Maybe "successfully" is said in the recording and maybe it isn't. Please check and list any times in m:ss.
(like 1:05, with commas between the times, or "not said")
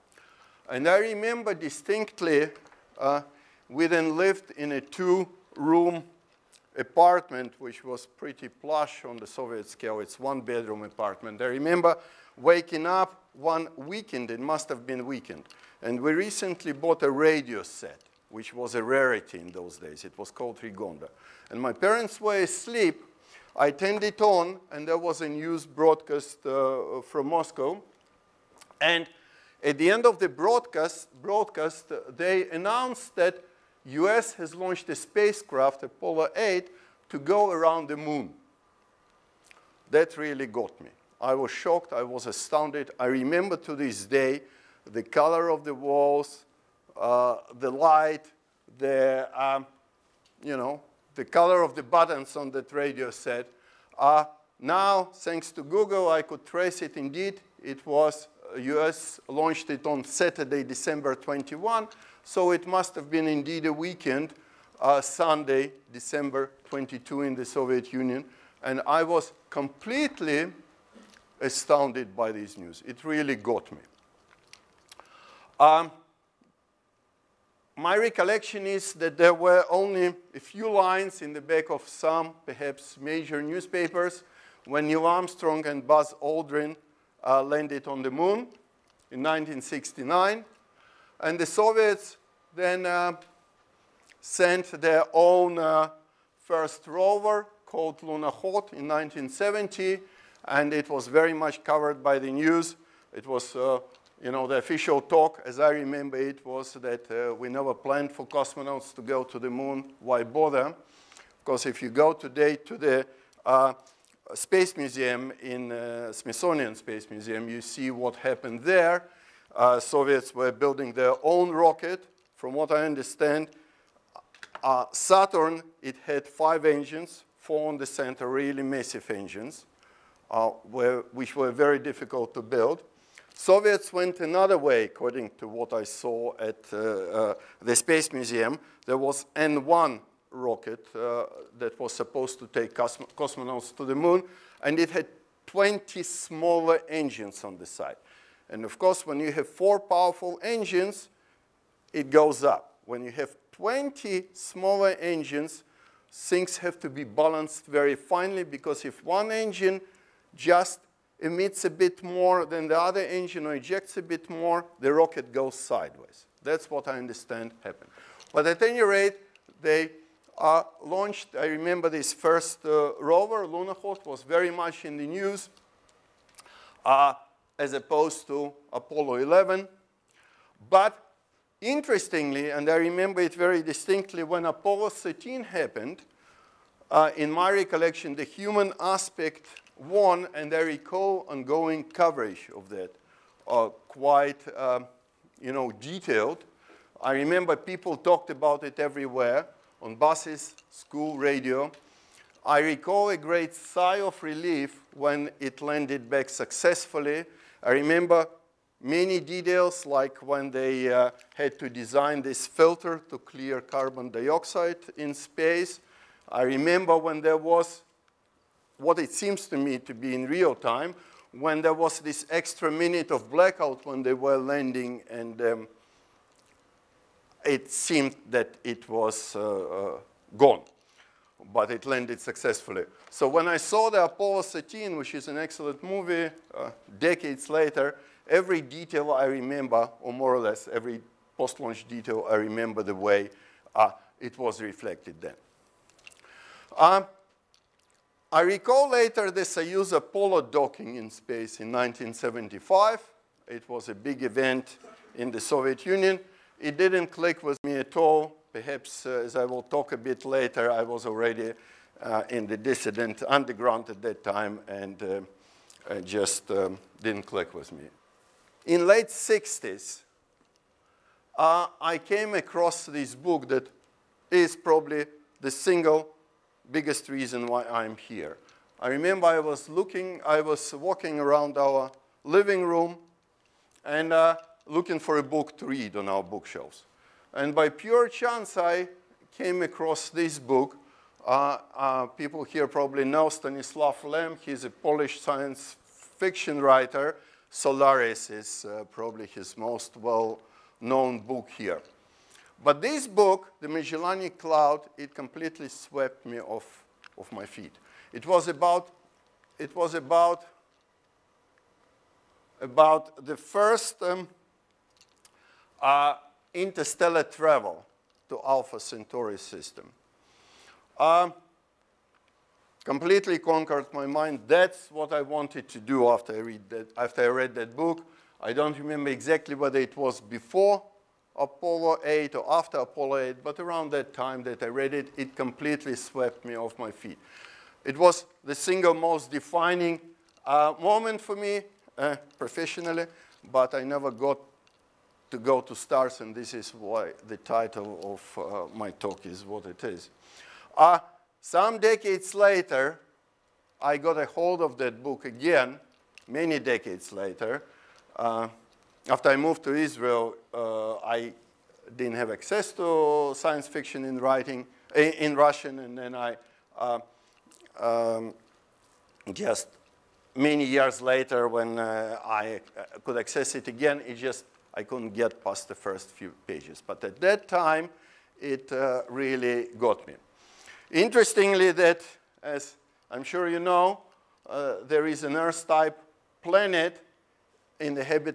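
3:26, 3:52.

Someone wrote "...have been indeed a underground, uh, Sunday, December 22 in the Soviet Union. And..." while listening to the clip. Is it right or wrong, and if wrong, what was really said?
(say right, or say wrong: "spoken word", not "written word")
wrong: "weekend", not "underground".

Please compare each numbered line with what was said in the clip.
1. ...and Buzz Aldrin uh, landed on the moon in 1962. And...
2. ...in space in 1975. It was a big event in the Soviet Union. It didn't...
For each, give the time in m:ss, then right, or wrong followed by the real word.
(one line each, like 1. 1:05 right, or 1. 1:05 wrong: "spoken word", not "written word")
1. 1:25 wrong: "1969", not "1962"
2. 4:10 right.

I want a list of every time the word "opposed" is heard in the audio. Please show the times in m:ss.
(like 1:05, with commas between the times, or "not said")
2:57.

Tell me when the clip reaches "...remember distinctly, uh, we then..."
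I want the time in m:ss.
0:00.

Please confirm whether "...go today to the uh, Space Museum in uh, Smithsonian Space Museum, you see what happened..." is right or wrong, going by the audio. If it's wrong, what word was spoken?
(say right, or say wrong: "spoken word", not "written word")
right.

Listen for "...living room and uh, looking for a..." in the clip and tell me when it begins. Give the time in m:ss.
4:42.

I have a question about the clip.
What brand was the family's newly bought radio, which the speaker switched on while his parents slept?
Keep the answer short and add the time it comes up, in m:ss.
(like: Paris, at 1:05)
Rigonda, at 0:20.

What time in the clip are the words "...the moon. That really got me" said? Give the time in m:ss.
0:37.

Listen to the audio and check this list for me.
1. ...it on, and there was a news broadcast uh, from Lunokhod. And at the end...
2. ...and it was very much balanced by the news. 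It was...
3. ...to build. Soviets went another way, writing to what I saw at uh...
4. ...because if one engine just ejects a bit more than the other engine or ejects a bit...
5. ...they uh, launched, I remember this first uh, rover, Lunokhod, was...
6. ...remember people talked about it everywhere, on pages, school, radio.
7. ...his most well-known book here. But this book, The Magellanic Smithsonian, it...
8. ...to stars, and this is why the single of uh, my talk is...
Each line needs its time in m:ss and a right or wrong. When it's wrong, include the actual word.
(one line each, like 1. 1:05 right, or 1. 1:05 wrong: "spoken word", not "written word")
1. 0:24 wrong: "Moscow", not "Lunokhod"
2. 1:40 wrong: "covered", not "balanced"
3. 2:12 wrong: "according", not "writing"
4. 2:38 wrong: "emits", not "ejects"
5. 2:49 right
6. 3:17 wrong: "buses", not "pages"
7. 4:59 wrong: "Cloud", not "Smithsonian"
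8. 5:45 wrong: "title", not "single".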